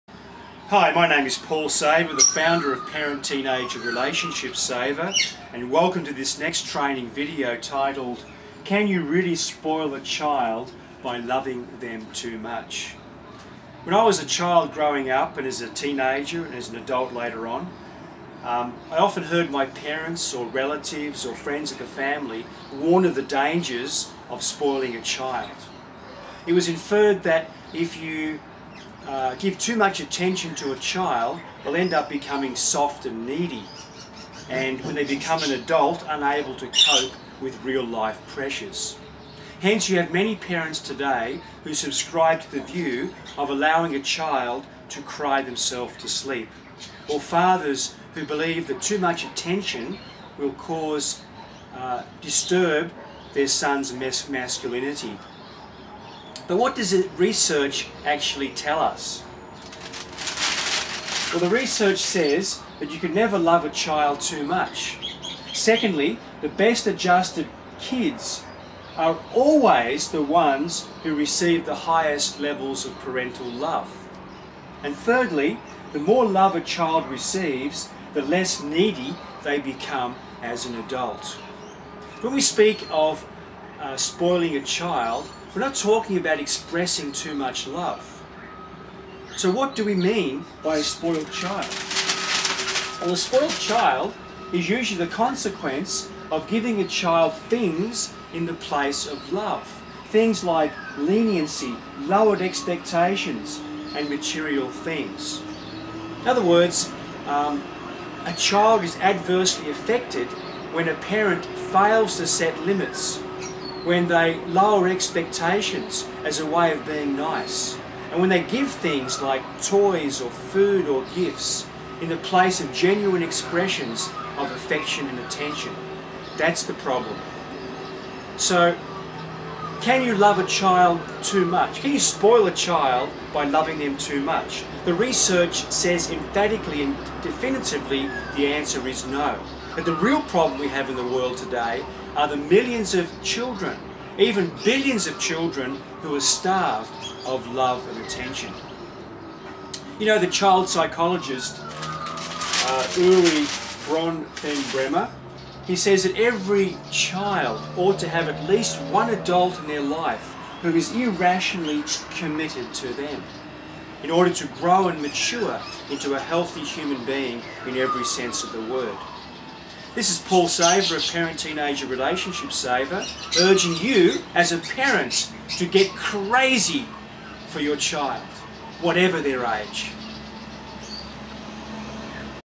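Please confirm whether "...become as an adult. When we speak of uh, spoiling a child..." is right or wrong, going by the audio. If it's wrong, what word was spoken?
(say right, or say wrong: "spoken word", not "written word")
right.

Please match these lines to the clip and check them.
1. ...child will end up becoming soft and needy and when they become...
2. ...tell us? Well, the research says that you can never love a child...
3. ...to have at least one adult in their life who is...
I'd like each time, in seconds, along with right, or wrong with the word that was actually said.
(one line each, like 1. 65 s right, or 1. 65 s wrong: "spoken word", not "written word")
1. 30 s right
2. 58 s right
3. 157 s right.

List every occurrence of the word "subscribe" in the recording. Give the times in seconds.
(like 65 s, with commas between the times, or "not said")
41 s.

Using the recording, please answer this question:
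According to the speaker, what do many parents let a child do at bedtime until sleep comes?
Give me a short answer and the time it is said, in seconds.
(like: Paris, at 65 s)
cry themselves to sleep, at 45 s.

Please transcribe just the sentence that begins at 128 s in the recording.
So, can you love a child too much?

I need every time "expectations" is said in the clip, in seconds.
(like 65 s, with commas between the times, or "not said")
102 s, 114 s.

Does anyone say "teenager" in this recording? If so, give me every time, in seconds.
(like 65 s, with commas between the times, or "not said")
3 s, 15 s, 171 s.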